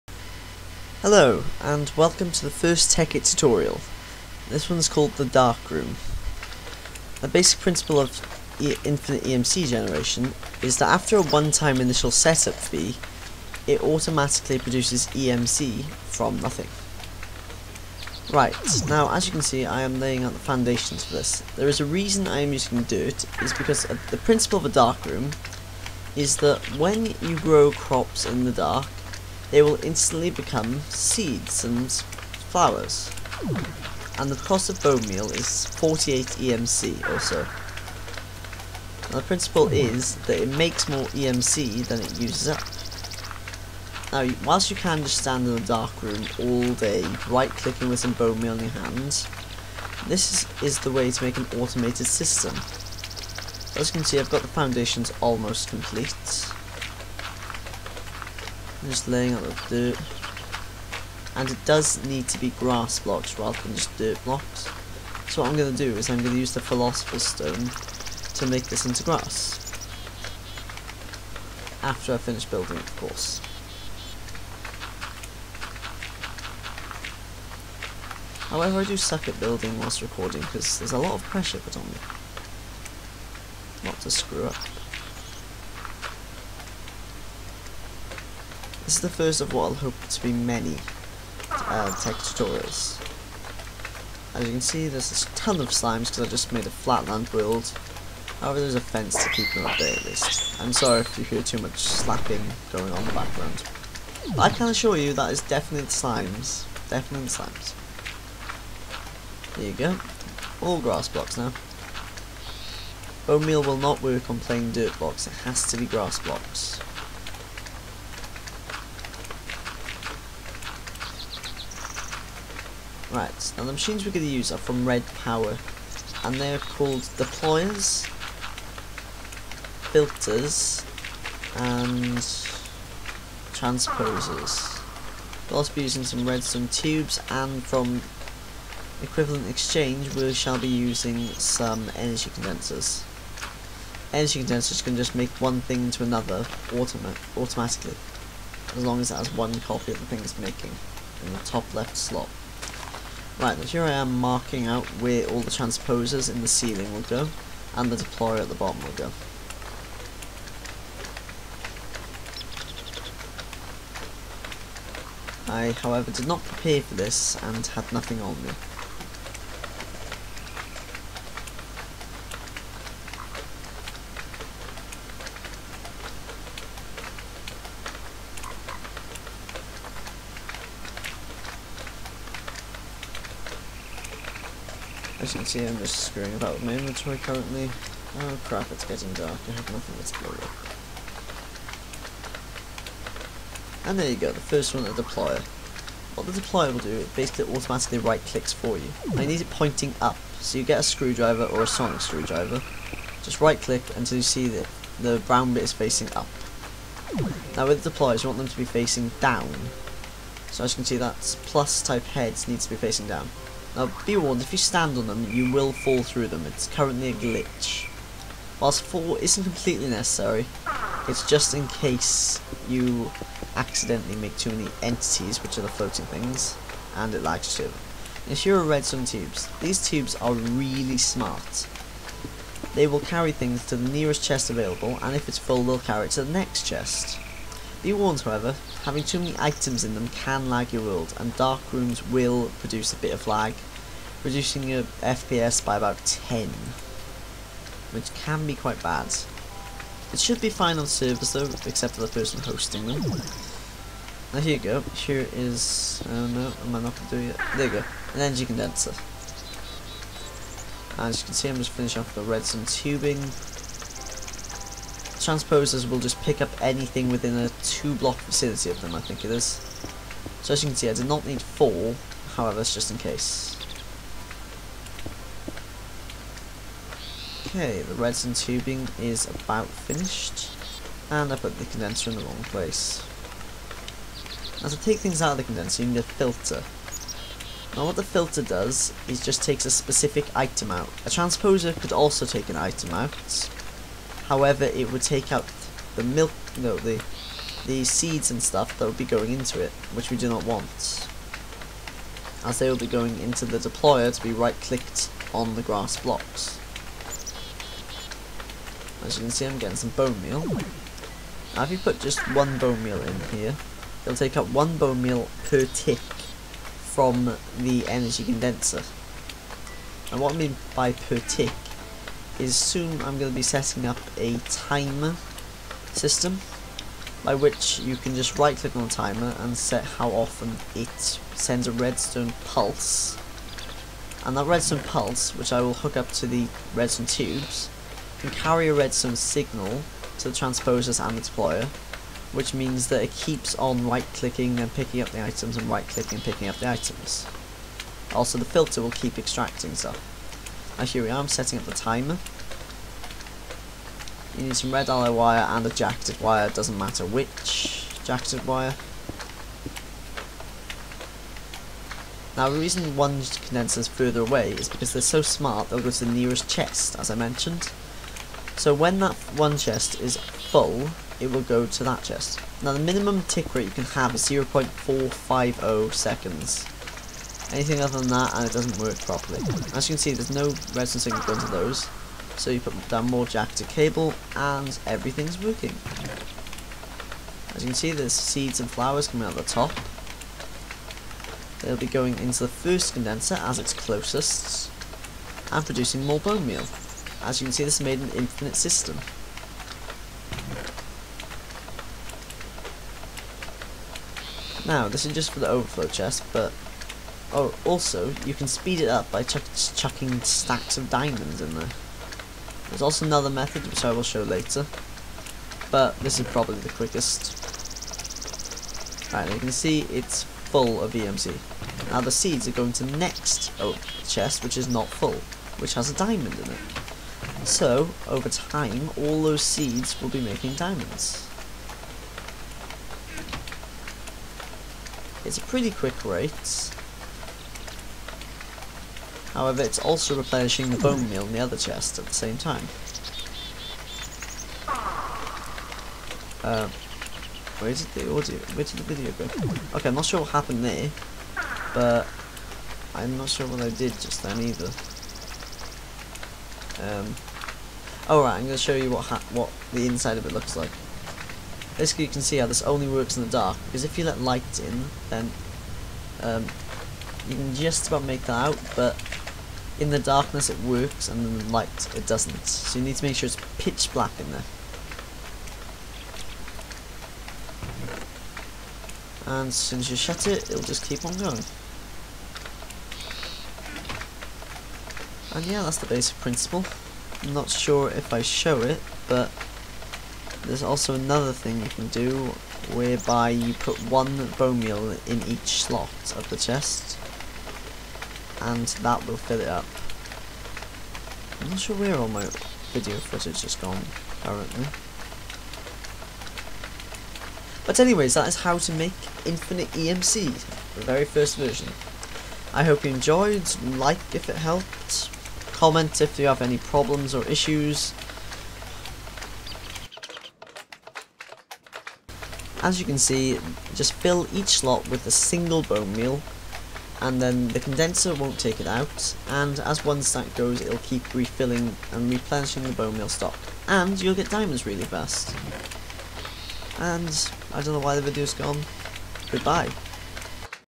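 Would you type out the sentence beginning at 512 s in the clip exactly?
I hope you enjoyed, like if it helped, comment if you have any problems or issues.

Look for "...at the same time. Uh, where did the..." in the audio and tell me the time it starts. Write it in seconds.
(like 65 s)
441 s.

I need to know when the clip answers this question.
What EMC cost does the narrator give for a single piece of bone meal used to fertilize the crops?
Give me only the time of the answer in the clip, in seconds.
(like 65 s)
35 s.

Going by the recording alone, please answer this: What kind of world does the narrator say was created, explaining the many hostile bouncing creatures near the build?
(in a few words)
Flatland world.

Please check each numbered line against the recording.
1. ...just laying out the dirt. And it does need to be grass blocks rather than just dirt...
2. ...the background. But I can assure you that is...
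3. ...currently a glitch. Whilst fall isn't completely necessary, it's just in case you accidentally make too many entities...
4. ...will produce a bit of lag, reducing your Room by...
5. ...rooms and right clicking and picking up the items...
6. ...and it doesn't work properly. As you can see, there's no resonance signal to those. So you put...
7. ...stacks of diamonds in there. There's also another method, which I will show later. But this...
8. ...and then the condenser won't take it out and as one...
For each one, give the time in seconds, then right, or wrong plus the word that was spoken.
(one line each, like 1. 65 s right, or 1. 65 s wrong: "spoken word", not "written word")
1. 58 s right
2. 103 s right
3. 216 s right
4. 242 s wrong: "FPS", not "Room"
5. 345 s wrong: "items", not "rooms"
6. 378 s right
7. 410 s right
8. 527 s right.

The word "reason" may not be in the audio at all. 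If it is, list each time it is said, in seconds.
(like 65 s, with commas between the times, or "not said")
21 s, 362 s.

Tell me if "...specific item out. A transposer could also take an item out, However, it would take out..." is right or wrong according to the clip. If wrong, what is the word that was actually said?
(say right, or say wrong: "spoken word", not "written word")
right.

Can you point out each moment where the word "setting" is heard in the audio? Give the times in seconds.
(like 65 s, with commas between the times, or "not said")
323 s, 351 s.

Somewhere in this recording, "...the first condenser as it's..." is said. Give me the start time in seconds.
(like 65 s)
392 s.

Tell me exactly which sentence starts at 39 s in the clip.
Now the principle is that it makes more EMC than it uses up.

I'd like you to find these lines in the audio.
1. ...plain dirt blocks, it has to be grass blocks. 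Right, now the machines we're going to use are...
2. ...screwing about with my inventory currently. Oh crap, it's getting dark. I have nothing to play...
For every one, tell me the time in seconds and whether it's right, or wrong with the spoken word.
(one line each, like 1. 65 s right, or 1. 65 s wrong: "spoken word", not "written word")
1. 114 s right
2. 185 s right.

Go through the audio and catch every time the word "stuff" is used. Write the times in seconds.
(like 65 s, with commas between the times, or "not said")
298 s, 349 s.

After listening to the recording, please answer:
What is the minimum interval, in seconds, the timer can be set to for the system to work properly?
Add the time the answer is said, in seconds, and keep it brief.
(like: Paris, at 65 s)
0.450 seconds, at 374 s.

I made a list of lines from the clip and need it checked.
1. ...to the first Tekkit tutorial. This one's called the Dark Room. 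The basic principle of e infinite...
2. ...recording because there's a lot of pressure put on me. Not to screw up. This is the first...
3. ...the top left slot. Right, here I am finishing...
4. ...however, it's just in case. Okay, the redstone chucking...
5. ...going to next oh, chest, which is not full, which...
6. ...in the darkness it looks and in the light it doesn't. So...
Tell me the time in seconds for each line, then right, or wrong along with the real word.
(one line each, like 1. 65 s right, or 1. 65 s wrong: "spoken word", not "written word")
1. 2 s right
2. 80 s right
3. 151 s wrong: "marking", not "finishing"
4. 272 s wrong: "tubing", not "chucking"
5. 422 s right
6. 469 s wrong: "works", not "looks".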